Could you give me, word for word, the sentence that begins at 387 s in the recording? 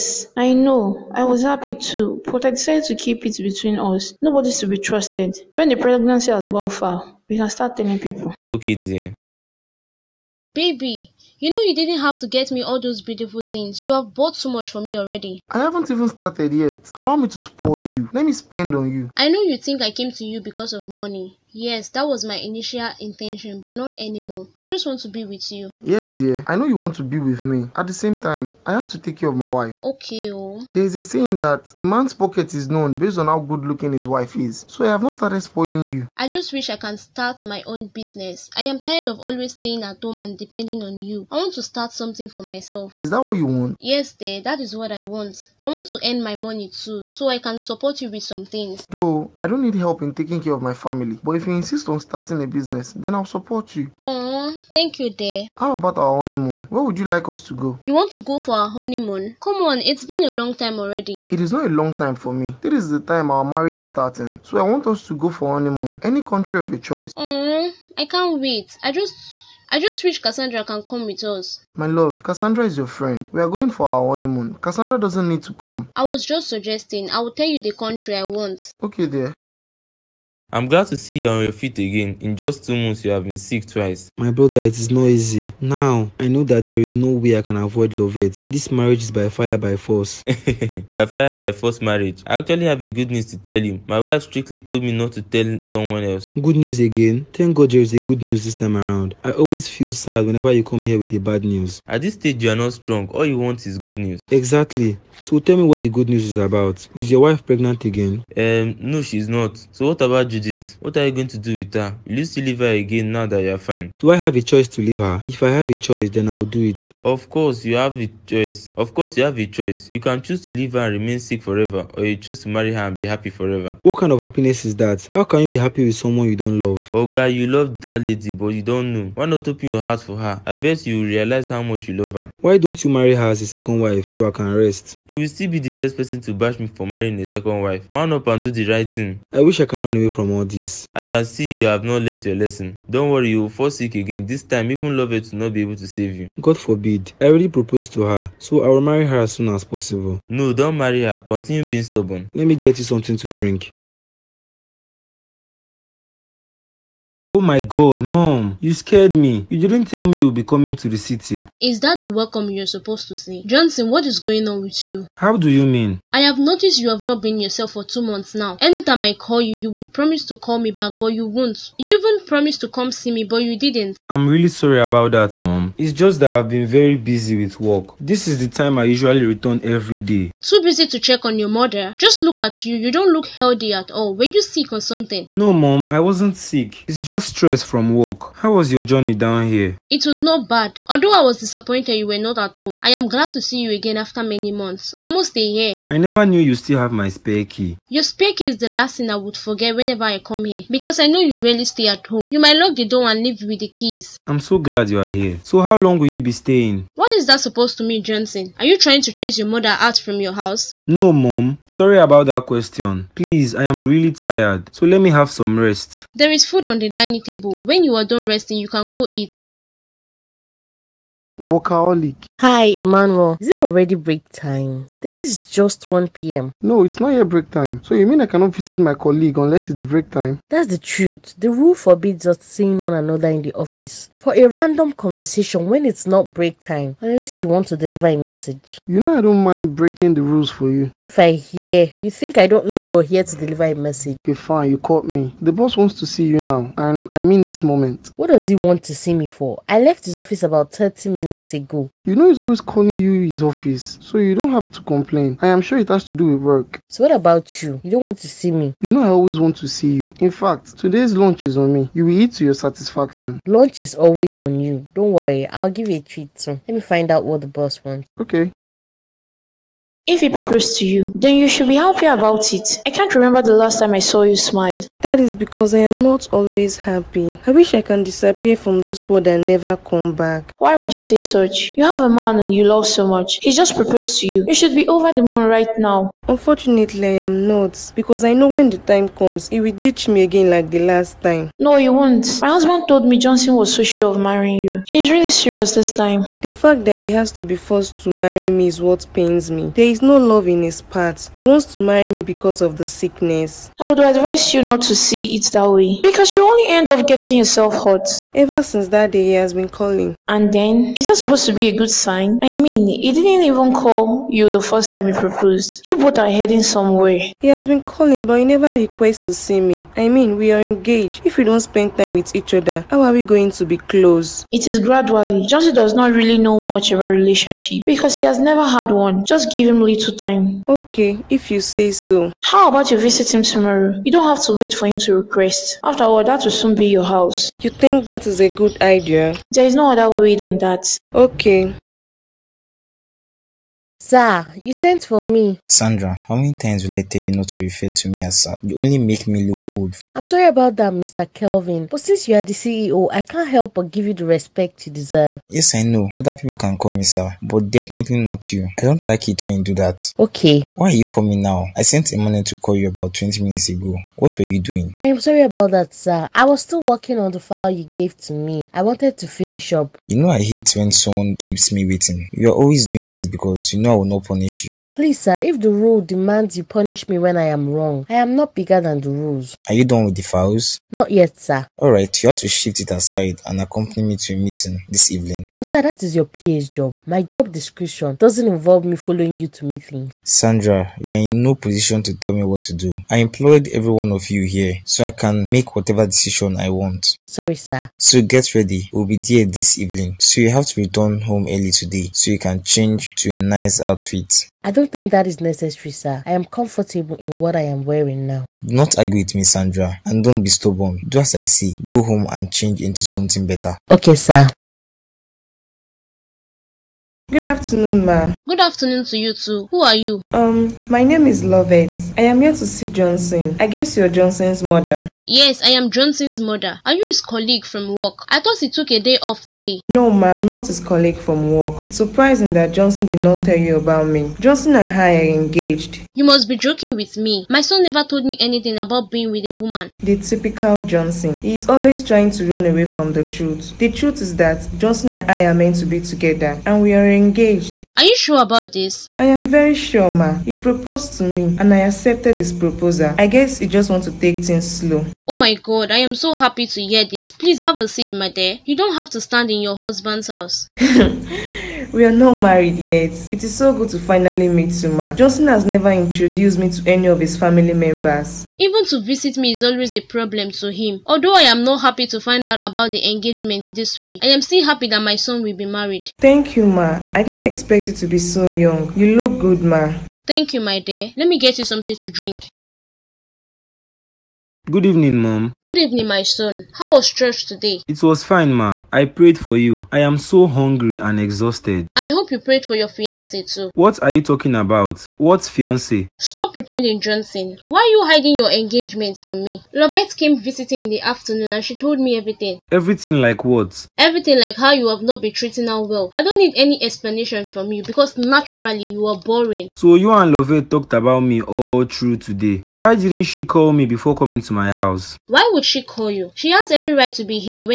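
My job description doesn't involve me following you to meetings.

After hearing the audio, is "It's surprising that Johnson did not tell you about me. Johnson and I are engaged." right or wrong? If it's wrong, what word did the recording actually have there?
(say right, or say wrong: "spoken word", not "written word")
right.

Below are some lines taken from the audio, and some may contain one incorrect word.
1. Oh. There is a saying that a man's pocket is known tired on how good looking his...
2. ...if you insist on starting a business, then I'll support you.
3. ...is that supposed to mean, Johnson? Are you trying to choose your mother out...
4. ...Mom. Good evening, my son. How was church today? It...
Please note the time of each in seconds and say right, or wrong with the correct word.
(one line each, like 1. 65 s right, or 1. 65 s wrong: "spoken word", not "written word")
1. 30 s wrong: "based", not "tired"
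2. 51 s right
3. 207 s wrong: "chase", not "choose"
4. 485 s right.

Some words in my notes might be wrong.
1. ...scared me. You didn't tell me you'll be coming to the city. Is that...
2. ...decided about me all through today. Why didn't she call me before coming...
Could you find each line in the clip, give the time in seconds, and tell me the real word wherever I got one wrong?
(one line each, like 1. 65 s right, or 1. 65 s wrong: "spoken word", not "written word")
1. 158 s right
2. 510 s wrong: "talked", not "decided".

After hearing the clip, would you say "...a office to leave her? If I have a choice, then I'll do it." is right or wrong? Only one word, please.
wrong.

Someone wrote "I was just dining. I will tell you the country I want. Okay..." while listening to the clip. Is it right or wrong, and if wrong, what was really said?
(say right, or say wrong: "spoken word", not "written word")
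wrong: "suggesting", not "dining".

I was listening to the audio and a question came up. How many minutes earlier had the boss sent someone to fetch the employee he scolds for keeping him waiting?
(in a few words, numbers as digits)
20.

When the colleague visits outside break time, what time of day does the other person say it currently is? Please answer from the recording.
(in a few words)
1 p.m.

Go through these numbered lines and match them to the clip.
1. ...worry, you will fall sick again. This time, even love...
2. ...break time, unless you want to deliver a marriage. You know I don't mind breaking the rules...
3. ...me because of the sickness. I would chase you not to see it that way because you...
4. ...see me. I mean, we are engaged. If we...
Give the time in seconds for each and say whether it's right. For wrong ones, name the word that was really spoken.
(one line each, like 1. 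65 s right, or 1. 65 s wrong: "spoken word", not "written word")
1. 143 s right
2. 236 s wrong: "message", not "marriage"
3. 302 s wrong: "advise", not "chase"
4. 319 s right.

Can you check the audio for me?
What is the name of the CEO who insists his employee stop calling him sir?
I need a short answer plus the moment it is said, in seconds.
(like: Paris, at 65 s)
Mr. Kelvin, at 350 s.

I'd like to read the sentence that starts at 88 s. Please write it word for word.
This marriage is by fire, by force.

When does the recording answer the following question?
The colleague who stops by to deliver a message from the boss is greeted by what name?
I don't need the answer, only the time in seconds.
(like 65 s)
222 s.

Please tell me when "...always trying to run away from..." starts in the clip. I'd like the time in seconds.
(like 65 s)
441 s.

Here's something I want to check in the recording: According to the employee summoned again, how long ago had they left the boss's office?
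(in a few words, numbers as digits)
30 minutes.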